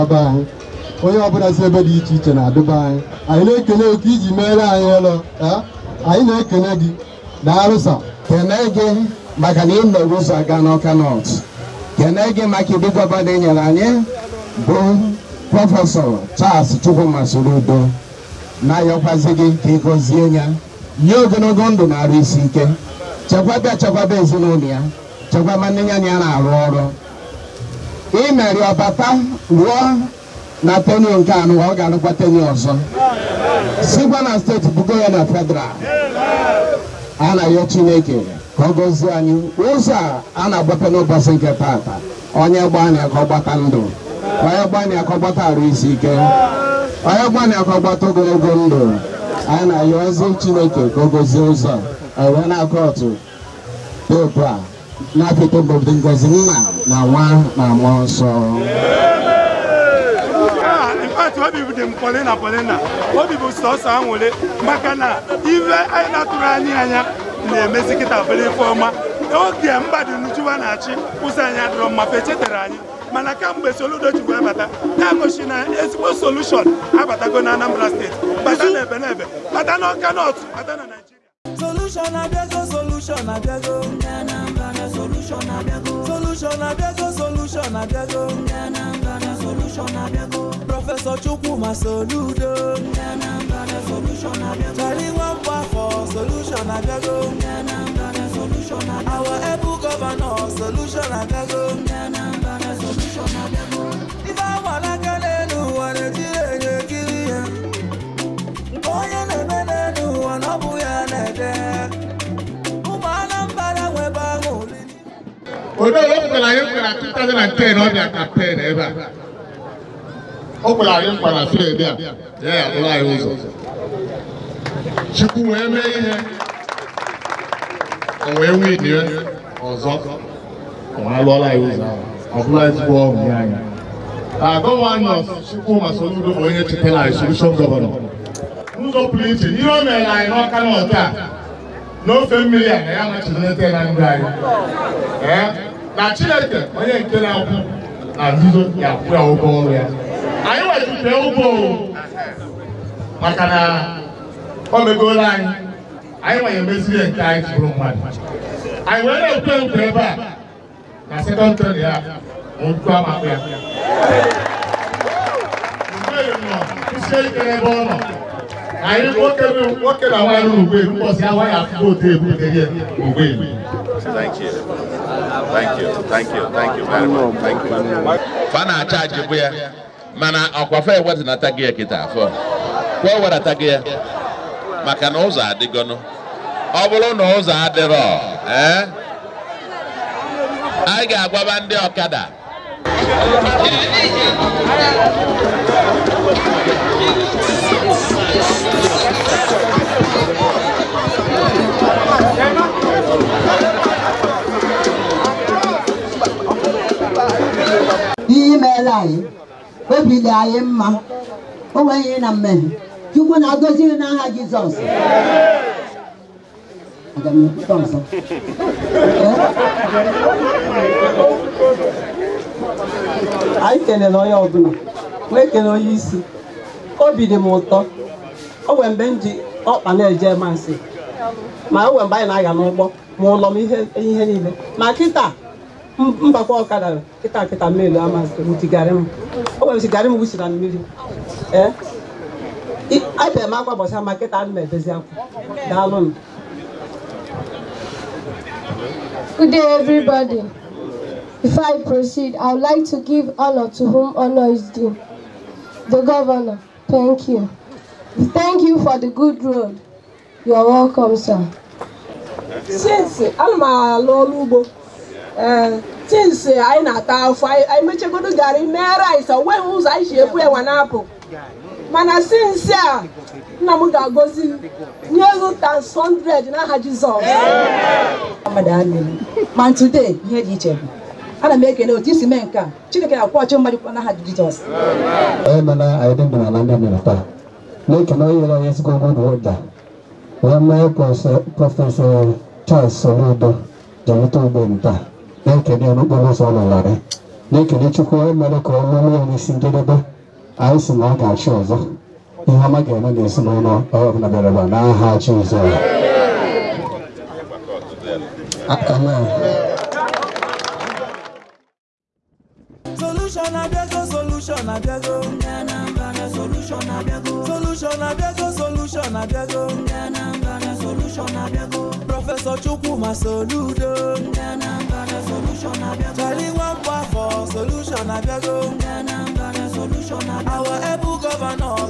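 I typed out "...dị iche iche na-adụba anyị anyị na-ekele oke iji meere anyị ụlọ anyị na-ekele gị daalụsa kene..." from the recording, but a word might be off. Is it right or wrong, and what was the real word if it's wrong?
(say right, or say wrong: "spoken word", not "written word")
right.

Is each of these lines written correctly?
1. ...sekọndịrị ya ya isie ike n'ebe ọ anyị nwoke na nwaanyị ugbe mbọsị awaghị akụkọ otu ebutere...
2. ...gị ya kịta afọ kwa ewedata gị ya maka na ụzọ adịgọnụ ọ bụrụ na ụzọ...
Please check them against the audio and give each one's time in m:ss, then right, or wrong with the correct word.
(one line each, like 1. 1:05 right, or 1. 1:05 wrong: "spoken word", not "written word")
1. 2:41 right
2. 3:01 right.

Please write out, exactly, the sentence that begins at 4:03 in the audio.
abịa m akwa gbasa ma kịta m na-edozi akwa daalụ m Good day, everybody.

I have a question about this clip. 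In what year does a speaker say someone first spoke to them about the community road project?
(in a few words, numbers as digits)
2010.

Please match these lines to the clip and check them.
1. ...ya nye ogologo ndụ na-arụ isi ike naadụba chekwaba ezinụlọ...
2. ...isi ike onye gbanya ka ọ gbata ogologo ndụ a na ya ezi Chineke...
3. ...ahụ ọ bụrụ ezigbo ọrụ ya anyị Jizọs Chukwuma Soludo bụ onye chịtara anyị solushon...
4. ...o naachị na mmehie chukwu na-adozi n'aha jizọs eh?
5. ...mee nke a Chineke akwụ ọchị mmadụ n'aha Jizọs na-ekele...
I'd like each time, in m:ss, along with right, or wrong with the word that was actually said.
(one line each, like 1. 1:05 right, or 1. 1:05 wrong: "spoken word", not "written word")
1. 0:20 wrong: "chekwaba", not "naadụba"
2. 0:45 right
3. 2:12 wrong: "Gọvanọ", not "Jizọs"
4. 3:31 wrong: "nweghị", not "naachị"
5. 4:42 right.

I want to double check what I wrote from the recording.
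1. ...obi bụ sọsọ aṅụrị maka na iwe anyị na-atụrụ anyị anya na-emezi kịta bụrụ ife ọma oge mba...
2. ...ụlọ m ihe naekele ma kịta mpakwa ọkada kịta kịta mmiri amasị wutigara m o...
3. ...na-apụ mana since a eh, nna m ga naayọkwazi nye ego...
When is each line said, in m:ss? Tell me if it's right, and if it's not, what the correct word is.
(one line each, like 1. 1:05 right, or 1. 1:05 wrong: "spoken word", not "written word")
1. 1:03 right
2. 3:53 wrong: "niile", not "naekele"
3. 4:30 wrong: "agozi", not "naayọkwazi".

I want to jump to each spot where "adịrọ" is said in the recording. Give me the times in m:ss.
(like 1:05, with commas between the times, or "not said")
1:11, 3:07.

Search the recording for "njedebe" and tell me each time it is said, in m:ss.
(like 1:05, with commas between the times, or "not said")
4:59.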